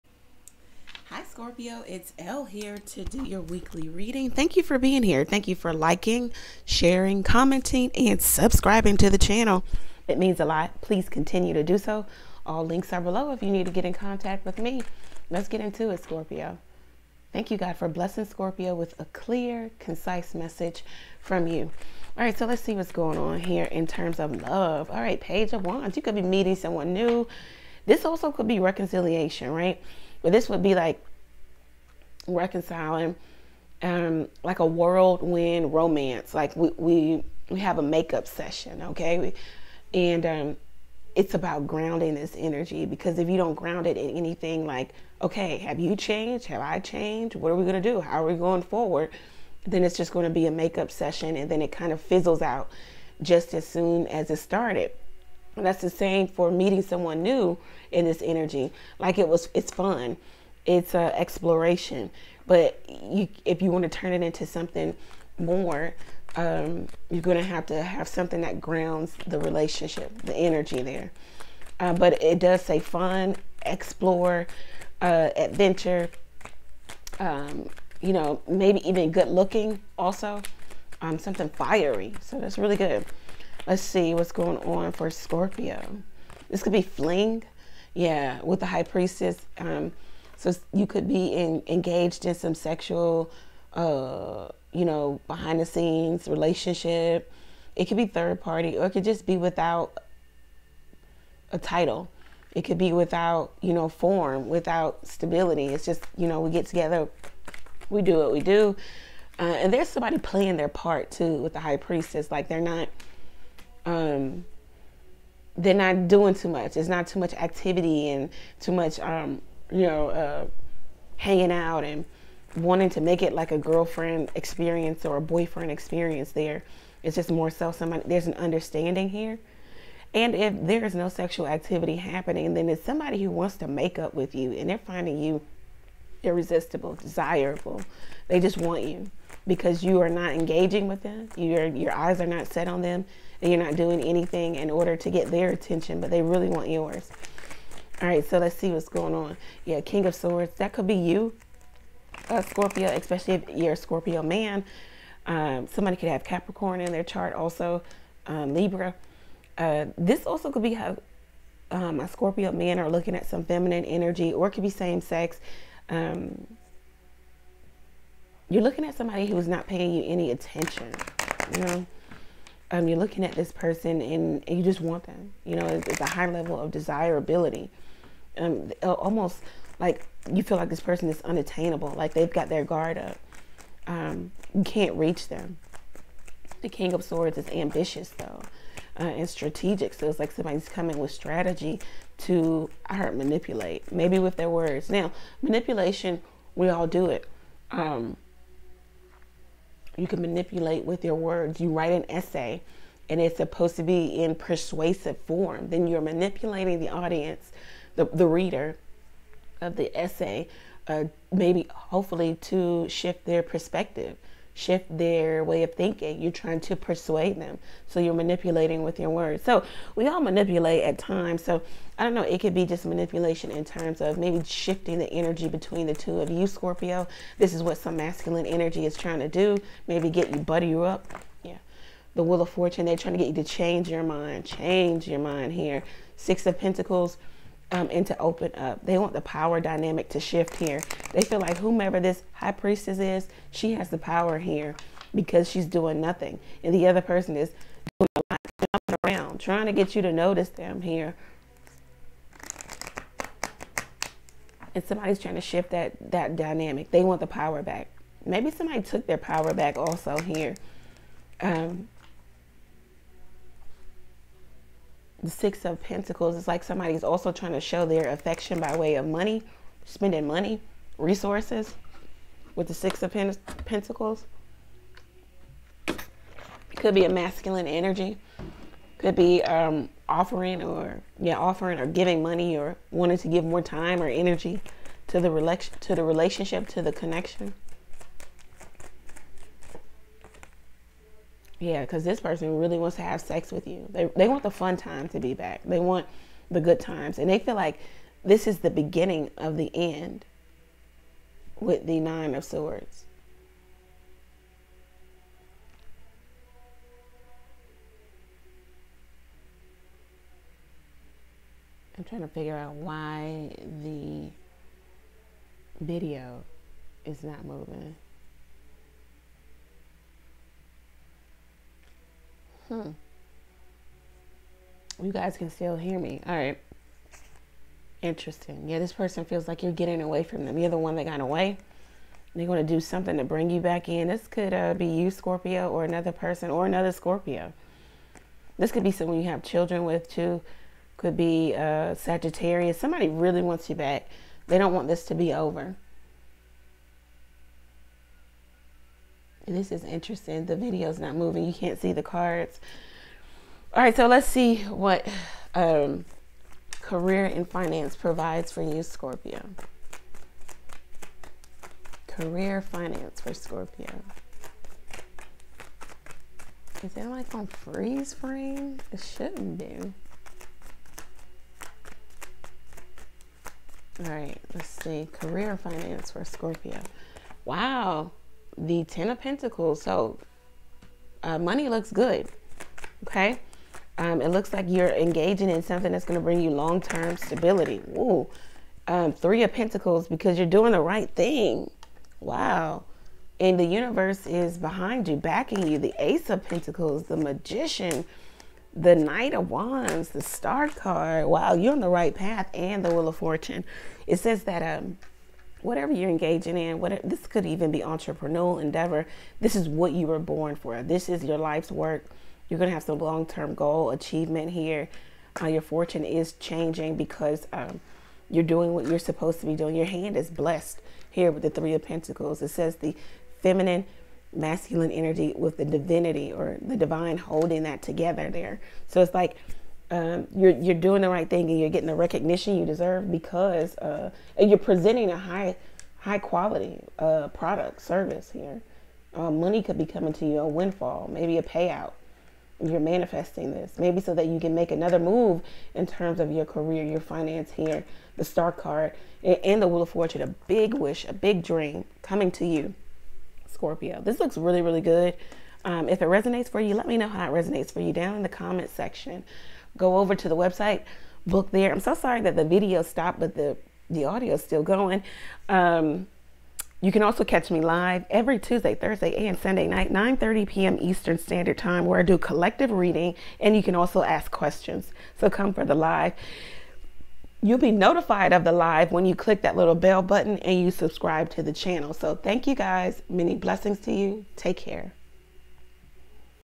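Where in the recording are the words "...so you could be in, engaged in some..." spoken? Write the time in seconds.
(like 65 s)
90 s.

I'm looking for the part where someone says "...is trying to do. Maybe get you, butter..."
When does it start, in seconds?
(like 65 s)
228 s.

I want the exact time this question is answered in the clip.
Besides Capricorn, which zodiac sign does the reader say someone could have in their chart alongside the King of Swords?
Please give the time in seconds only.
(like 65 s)
158 s.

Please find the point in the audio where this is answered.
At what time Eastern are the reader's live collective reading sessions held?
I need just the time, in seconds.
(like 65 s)
469 s.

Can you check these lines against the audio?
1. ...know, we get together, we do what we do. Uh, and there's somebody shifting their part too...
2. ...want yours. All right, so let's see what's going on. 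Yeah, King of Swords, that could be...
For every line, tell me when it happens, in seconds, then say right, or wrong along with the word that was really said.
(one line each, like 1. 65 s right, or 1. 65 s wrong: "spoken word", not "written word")
1. 106 s wrong: "playing", not "shifting"
2. 146 s right.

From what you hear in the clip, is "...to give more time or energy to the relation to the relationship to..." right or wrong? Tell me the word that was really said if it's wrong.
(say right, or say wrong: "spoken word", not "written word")
right.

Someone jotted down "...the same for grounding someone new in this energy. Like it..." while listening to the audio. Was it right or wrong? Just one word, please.
wrong.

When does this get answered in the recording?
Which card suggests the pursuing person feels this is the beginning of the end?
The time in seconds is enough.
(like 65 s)
301 s.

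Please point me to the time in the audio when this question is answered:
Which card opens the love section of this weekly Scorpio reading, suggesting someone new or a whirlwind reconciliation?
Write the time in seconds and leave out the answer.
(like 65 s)
25 s.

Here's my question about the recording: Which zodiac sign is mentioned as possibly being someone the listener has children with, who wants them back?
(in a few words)
Sagittarius.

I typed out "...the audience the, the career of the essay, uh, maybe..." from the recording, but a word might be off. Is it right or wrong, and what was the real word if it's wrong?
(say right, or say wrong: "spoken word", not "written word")
wrong: "reader", not "career".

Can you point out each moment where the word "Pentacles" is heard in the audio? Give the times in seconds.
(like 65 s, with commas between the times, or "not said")
236 s, 265 s, 273 s, 379 s, 389 s, 396 s, 421 s.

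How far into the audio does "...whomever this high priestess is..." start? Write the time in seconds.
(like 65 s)
241 s.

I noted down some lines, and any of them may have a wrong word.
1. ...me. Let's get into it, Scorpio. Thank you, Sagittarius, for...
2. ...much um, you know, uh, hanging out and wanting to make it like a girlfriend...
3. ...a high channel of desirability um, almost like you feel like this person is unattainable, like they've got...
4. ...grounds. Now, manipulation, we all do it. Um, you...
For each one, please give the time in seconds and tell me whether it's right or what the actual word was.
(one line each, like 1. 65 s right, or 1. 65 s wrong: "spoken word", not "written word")
1. 14 s wrong: "God", not "Sagittarius"
2. 118 s right
3. 176 s wrong: "level", not "channel"
4. 194 s wrong: "words", not "grounds".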